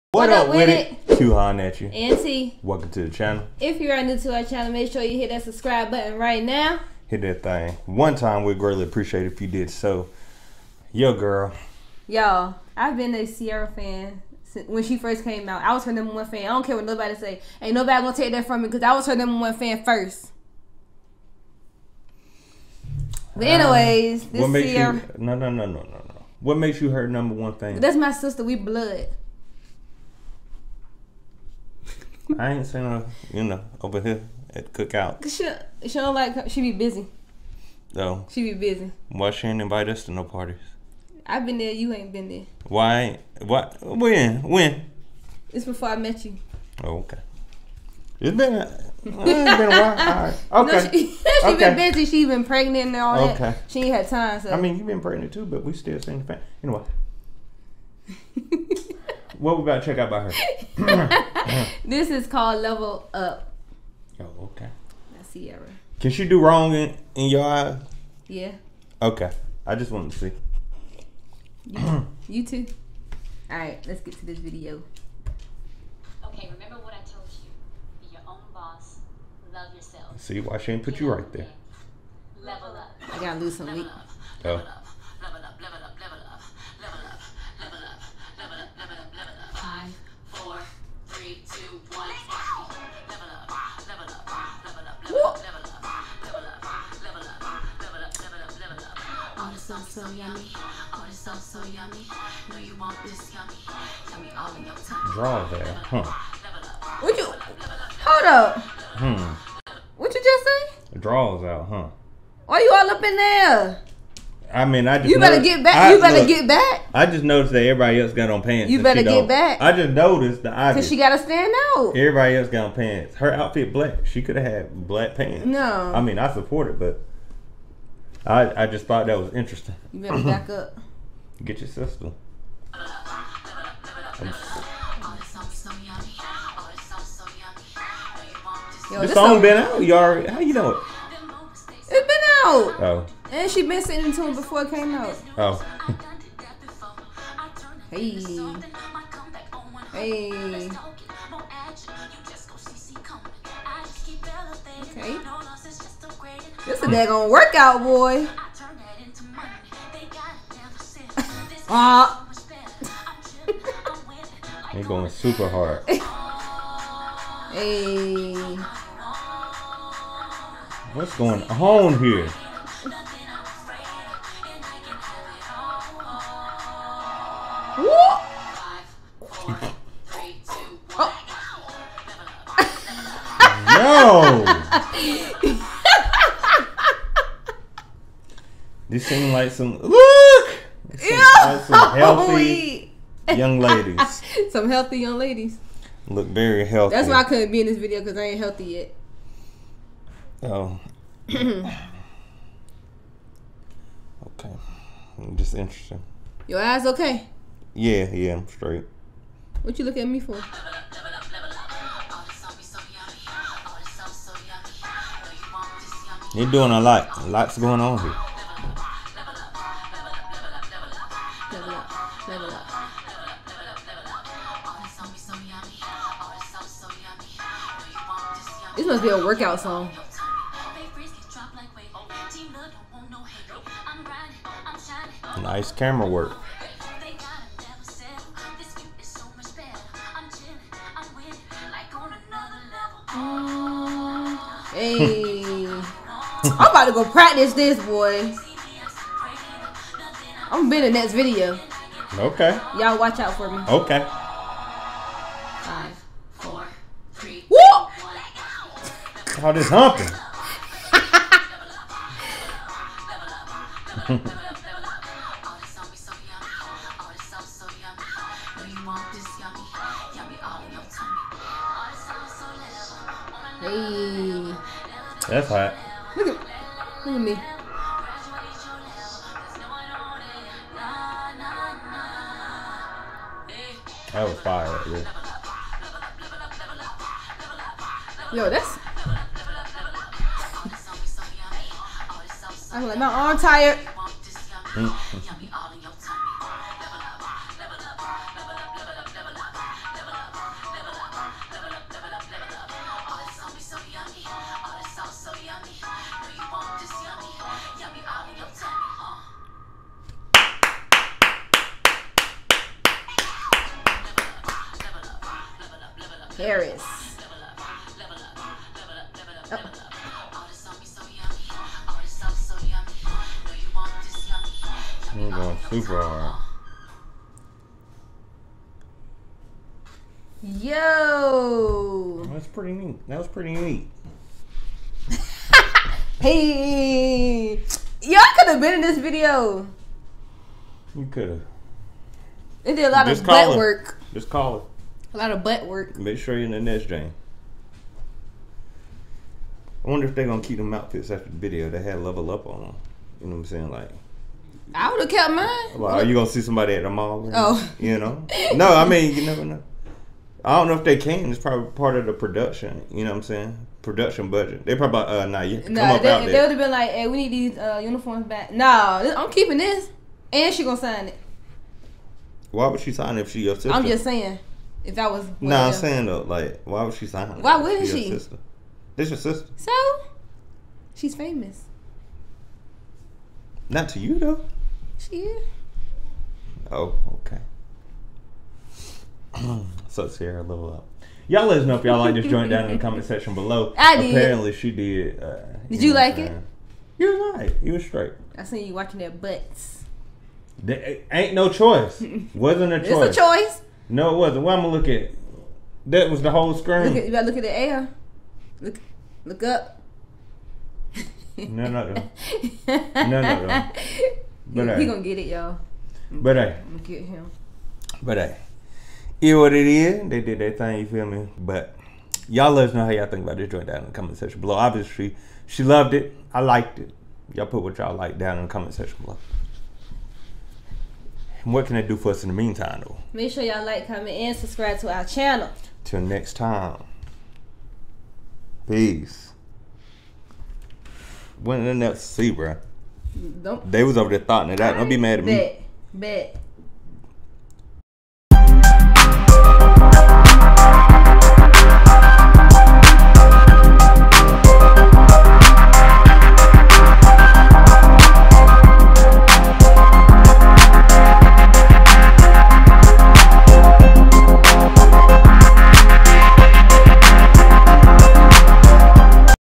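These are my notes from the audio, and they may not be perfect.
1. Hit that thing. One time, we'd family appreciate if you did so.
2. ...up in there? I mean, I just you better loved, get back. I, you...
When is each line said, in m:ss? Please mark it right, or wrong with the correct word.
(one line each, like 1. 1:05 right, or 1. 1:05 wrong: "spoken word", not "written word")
1. 0:07 wrong: "greatly", not "family"
2. 1:52 wrong: "noticed", not "loved".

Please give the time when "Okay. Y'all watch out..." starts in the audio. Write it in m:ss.
4:12.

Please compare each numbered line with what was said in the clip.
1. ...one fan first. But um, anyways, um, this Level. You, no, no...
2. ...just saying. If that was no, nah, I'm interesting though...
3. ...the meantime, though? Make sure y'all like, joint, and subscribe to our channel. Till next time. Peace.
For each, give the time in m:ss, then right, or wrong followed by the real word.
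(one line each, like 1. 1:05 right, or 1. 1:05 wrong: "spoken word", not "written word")
1. 0:19 wrong: "Ciara", not "Level"
2. 6:13 wrong: "saying", not "interesting"
3. 7:12 wrong: "comment", not "joint".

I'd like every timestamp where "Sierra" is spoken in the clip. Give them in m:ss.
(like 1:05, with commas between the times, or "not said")
1:05, 6:30.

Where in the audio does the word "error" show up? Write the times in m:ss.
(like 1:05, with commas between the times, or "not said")
not said.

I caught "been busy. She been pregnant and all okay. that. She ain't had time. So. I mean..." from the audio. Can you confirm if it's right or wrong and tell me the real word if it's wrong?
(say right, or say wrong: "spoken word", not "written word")
right.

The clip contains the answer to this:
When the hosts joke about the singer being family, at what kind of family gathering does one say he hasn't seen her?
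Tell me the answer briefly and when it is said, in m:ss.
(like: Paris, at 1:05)
cookout, at 0:34.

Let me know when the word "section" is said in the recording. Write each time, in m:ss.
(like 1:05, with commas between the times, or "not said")
6:33, 7:04, 7:08.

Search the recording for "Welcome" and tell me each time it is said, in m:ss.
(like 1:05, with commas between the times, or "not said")
0:02.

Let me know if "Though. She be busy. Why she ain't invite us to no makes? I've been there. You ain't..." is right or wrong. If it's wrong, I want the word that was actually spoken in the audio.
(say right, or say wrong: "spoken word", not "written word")
wrong: "parties", not "makes".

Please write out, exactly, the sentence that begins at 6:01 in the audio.
It's probably part of the production.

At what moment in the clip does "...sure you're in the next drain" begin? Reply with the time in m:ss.
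5:46.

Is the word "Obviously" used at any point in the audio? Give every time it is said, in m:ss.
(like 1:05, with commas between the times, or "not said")
7:04.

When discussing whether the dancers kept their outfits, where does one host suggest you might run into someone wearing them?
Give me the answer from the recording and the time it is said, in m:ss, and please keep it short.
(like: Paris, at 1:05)
the mall, at 5:56.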